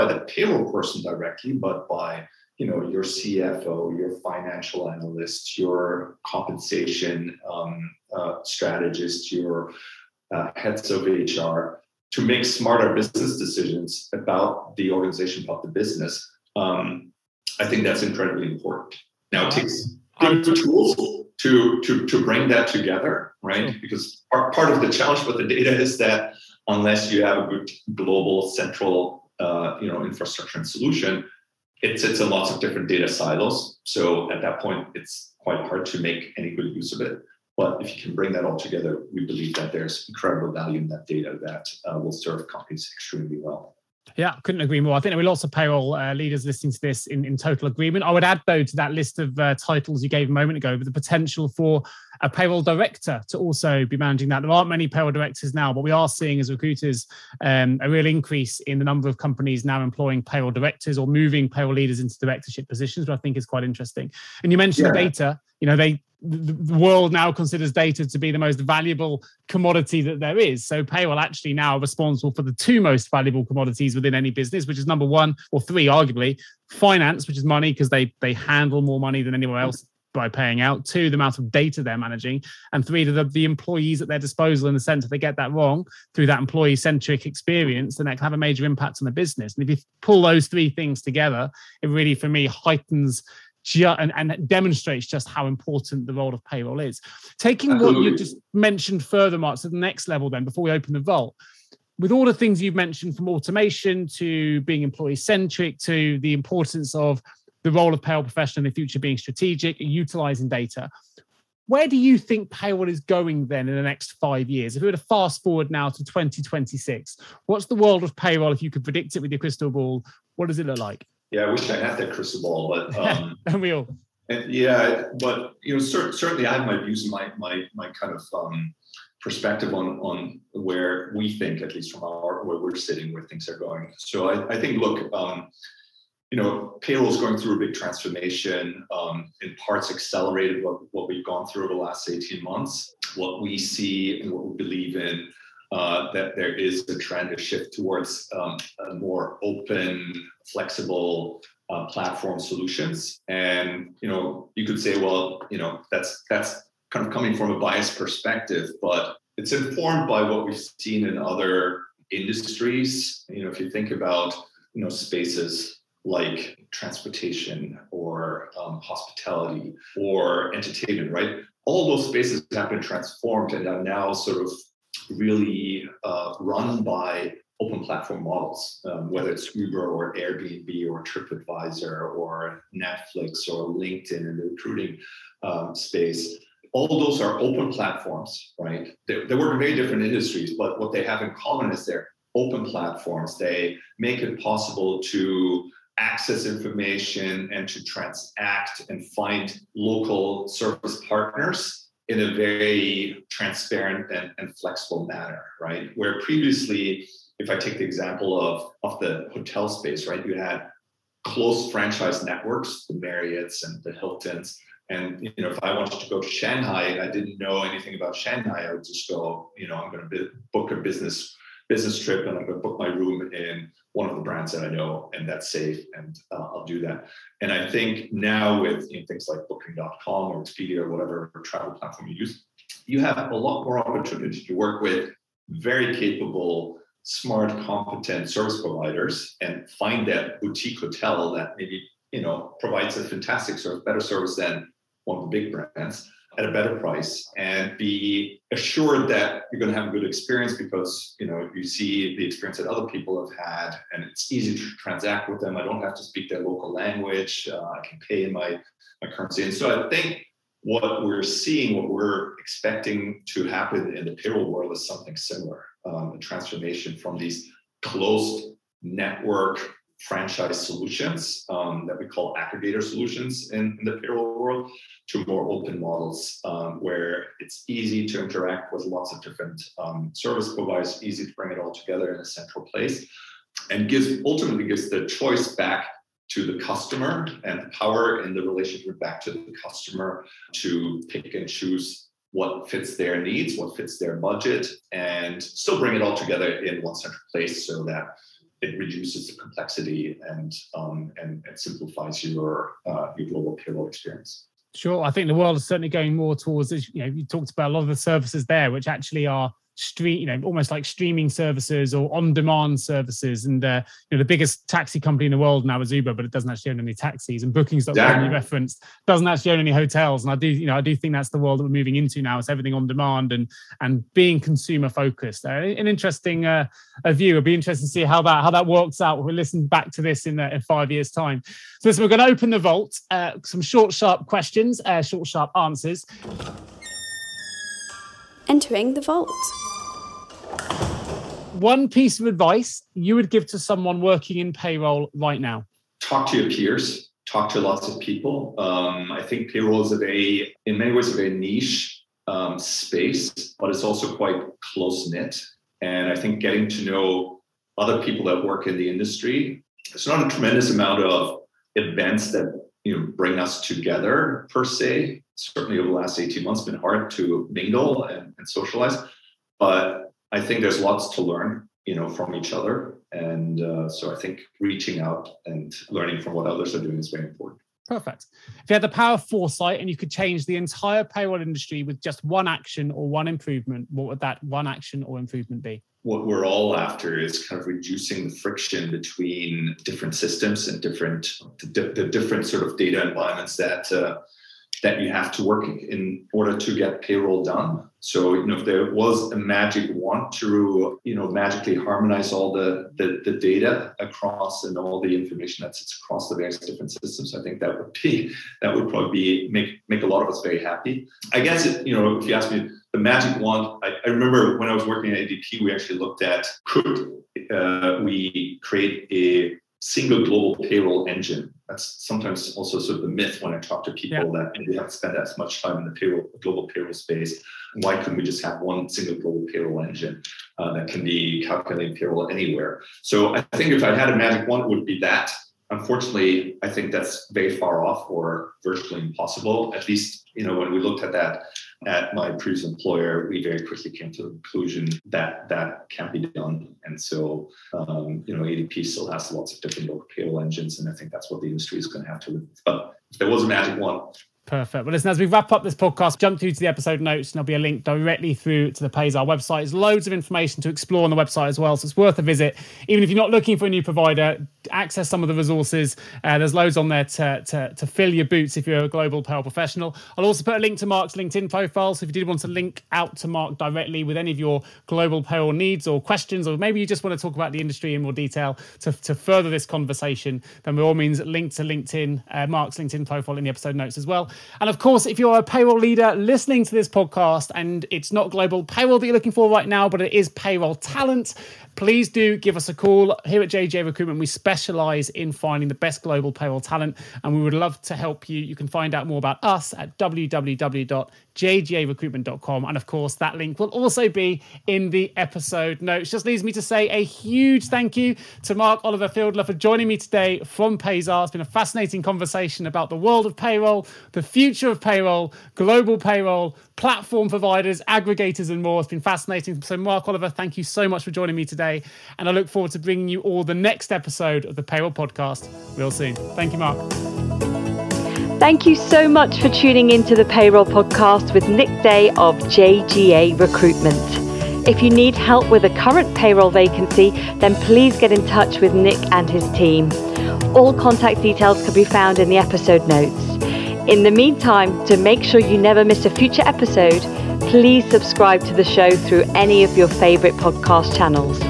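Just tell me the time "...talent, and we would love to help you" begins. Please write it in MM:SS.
08:16.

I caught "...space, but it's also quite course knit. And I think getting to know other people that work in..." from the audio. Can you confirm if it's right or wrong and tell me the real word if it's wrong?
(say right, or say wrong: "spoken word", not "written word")
wrong: "close", not "course".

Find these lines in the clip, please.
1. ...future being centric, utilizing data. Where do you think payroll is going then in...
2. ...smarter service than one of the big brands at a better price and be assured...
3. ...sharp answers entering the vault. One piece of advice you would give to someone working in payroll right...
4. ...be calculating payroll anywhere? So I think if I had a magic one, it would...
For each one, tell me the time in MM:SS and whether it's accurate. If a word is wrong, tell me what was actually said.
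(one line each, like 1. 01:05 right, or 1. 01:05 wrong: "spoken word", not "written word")
1. 01:48 wrong: "strategic", not "centric"
2. 04:03 wrong: "better", not "smarter"
3. 05:35 right
4. 07:11 right.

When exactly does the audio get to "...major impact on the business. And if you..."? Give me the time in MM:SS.
01:28.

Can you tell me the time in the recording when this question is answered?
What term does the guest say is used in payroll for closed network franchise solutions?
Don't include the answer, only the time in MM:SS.
04:32.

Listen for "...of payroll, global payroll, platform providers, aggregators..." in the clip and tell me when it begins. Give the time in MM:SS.
08:34.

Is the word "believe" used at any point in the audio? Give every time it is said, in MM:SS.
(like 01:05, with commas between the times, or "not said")
00:39, 02:24.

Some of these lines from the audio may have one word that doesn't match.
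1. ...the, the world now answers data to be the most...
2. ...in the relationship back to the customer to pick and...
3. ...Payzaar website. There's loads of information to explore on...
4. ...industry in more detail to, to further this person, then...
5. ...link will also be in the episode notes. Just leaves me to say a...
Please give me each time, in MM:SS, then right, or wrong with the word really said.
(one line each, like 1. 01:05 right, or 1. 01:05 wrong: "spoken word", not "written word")
1. 01:06 wrong: "considers", not "answers"
2. 04:48 right
3. 07:38 right
4. 07:57 wrong: "conversation", not "person"
5. 08:23 right.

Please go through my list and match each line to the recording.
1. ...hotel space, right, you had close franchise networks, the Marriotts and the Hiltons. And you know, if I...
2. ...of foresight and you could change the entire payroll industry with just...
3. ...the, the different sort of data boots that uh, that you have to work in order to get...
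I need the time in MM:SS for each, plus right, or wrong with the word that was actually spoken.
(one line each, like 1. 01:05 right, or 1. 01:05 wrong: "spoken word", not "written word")
1. 03:29 right
2. 06:19 right
3. 06:31 wrong: "environments", not "boots".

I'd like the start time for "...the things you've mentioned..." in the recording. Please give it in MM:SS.
01:42.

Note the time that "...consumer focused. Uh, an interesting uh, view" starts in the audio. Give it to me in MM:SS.
05:24.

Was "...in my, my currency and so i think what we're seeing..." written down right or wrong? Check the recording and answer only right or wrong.
right.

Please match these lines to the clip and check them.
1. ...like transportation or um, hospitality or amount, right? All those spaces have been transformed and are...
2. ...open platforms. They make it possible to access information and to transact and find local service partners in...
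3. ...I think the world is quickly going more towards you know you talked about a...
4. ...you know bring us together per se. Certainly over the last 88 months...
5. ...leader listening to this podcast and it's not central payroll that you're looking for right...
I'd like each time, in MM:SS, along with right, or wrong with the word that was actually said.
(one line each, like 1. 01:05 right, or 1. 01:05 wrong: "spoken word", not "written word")
1. 02:46 wrong: "entertainment", not "amount"
2. 03:12 right
3. 05:05 wrong: "certainly", not "quickly"
4. 06:02 wrong: "18", not "88"
5. 08:05 wrong: "global", not "central".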